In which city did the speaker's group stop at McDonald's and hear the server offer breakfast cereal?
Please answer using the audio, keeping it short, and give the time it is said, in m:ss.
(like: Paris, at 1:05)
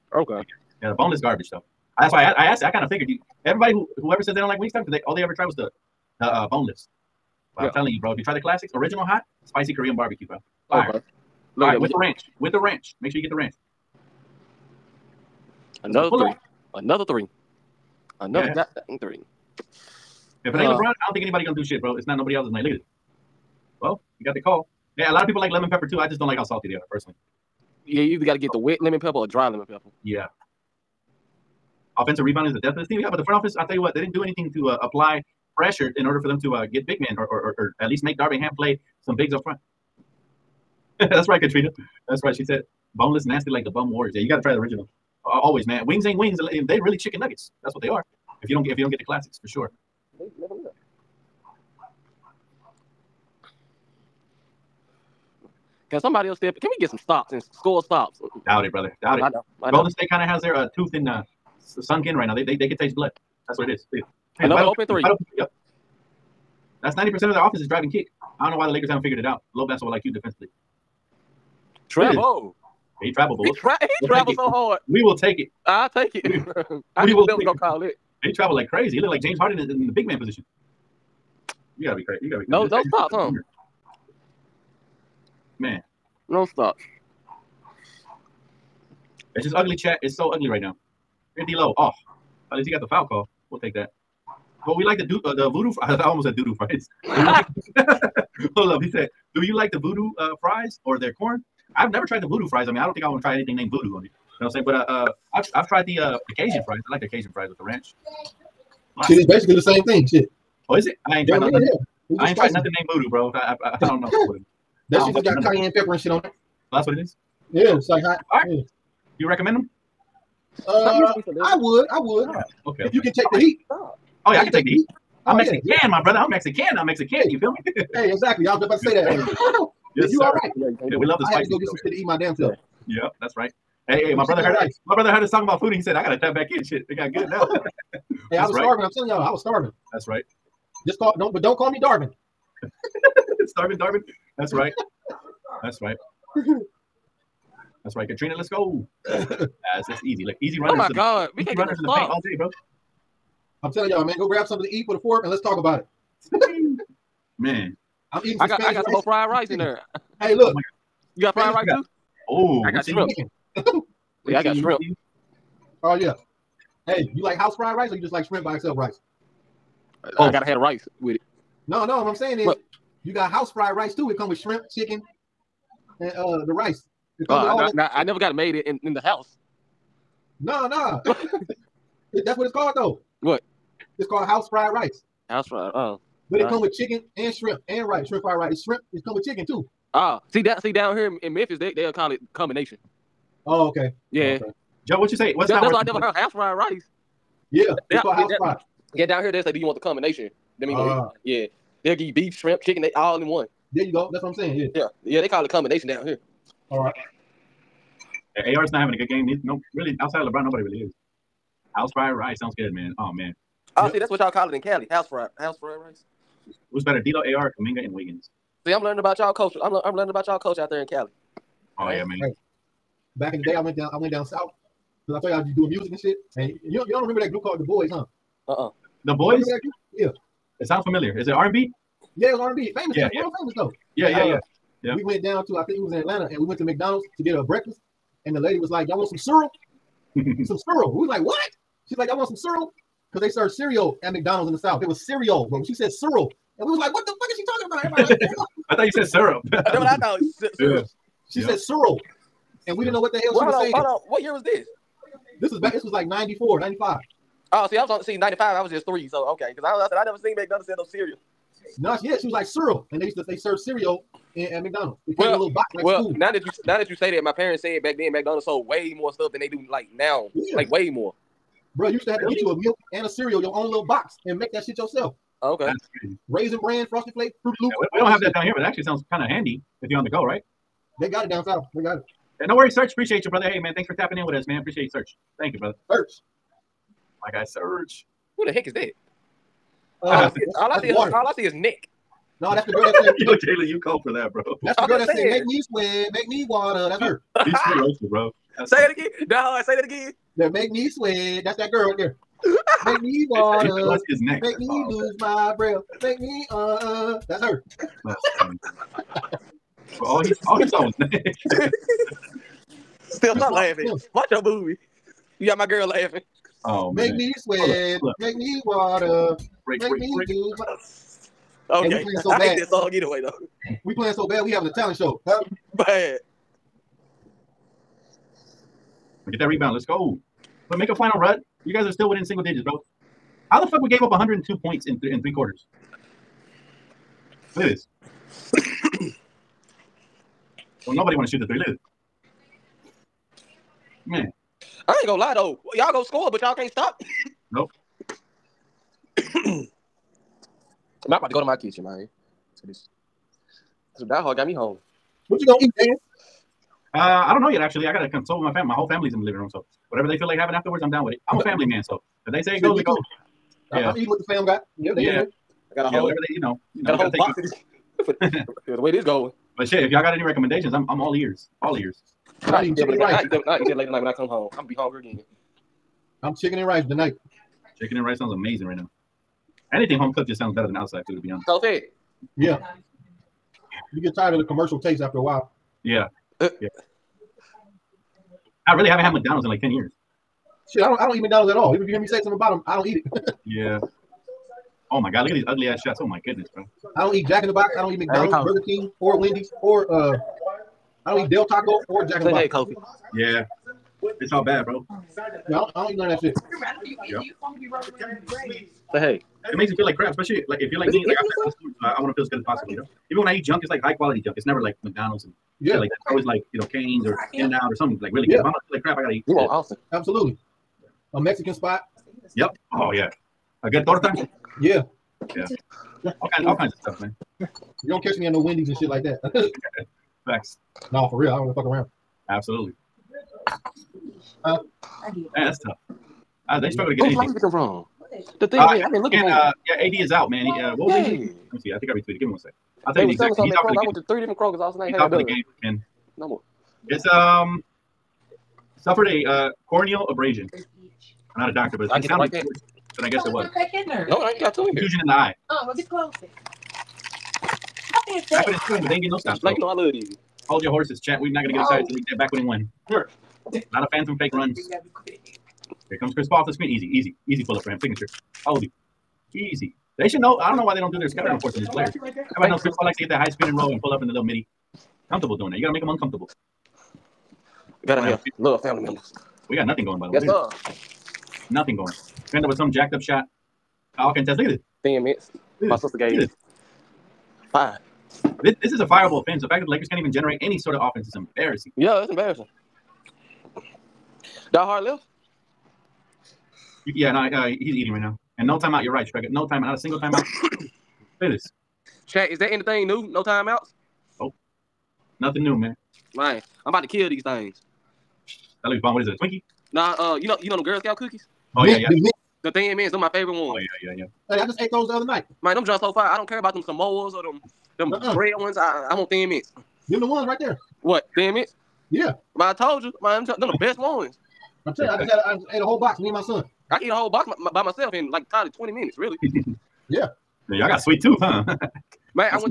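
Atlanta, at 3:55.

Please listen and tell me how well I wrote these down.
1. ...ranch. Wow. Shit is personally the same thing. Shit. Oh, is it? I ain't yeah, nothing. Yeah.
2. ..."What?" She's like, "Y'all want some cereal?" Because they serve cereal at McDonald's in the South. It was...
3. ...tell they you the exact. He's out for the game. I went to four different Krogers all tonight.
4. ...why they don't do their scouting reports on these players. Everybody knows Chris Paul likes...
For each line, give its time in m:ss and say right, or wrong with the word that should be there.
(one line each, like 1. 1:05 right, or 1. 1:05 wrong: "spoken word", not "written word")
1. 1:47 wrong: "basically", not "personally"
2. 4:01 right
3. 7:22 wrong: "three", not "four"
4. 7:50 right.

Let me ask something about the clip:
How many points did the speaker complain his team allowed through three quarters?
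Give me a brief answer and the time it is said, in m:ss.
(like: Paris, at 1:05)
102, at 5:34.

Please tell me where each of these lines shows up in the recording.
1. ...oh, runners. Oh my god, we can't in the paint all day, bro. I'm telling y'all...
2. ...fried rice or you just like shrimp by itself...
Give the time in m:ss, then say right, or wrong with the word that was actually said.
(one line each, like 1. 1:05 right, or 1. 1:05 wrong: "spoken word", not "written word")
1. 2:30 right
2. 2:47 right.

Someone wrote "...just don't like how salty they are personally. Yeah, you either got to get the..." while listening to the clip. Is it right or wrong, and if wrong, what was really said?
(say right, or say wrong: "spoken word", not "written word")
right.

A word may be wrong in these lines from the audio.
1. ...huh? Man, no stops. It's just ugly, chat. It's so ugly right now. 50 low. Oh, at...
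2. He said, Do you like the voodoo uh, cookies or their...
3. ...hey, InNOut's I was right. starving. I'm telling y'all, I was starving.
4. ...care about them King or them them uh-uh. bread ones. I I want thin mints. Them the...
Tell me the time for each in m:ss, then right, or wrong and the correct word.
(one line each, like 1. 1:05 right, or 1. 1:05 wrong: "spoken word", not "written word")
1. 1:23 right
2. 1:38 wrong: "fries", not "cookies"
3. 2:17 wrong: "That", not "InNOut"
4. 8:36 wrong: "Samoas", not "King".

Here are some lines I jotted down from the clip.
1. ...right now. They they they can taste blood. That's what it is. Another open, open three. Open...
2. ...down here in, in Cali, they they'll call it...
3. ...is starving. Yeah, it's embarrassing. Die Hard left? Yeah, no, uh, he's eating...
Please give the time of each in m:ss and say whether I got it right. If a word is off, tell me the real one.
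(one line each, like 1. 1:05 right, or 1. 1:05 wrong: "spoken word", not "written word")
1. 1:02 right
2. 3:10 wrong: "Memphis", not "Cali"
3. 8:11 wrong: "embarrassing", not "starving".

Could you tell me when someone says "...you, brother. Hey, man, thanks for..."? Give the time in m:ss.
4:43.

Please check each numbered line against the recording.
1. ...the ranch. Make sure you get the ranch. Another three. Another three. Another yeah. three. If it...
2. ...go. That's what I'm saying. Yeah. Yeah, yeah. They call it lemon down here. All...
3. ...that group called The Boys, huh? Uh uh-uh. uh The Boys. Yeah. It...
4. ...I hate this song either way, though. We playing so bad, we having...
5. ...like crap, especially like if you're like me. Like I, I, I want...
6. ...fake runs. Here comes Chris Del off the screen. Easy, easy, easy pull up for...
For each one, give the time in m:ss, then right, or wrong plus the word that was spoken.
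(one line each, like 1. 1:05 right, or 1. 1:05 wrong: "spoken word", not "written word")
1. 0:12 right
2. 3:23 wrong: "combination", not "lemon"
3. 3:47 right
4. 5:22 right
5. 6:49 right
6. 7:44 wrong: "Paul", not "Del".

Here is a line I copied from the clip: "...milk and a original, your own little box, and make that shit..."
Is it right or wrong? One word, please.
wrong.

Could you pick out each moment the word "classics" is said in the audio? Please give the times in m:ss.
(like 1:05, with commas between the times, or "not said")
0:08, 0:49.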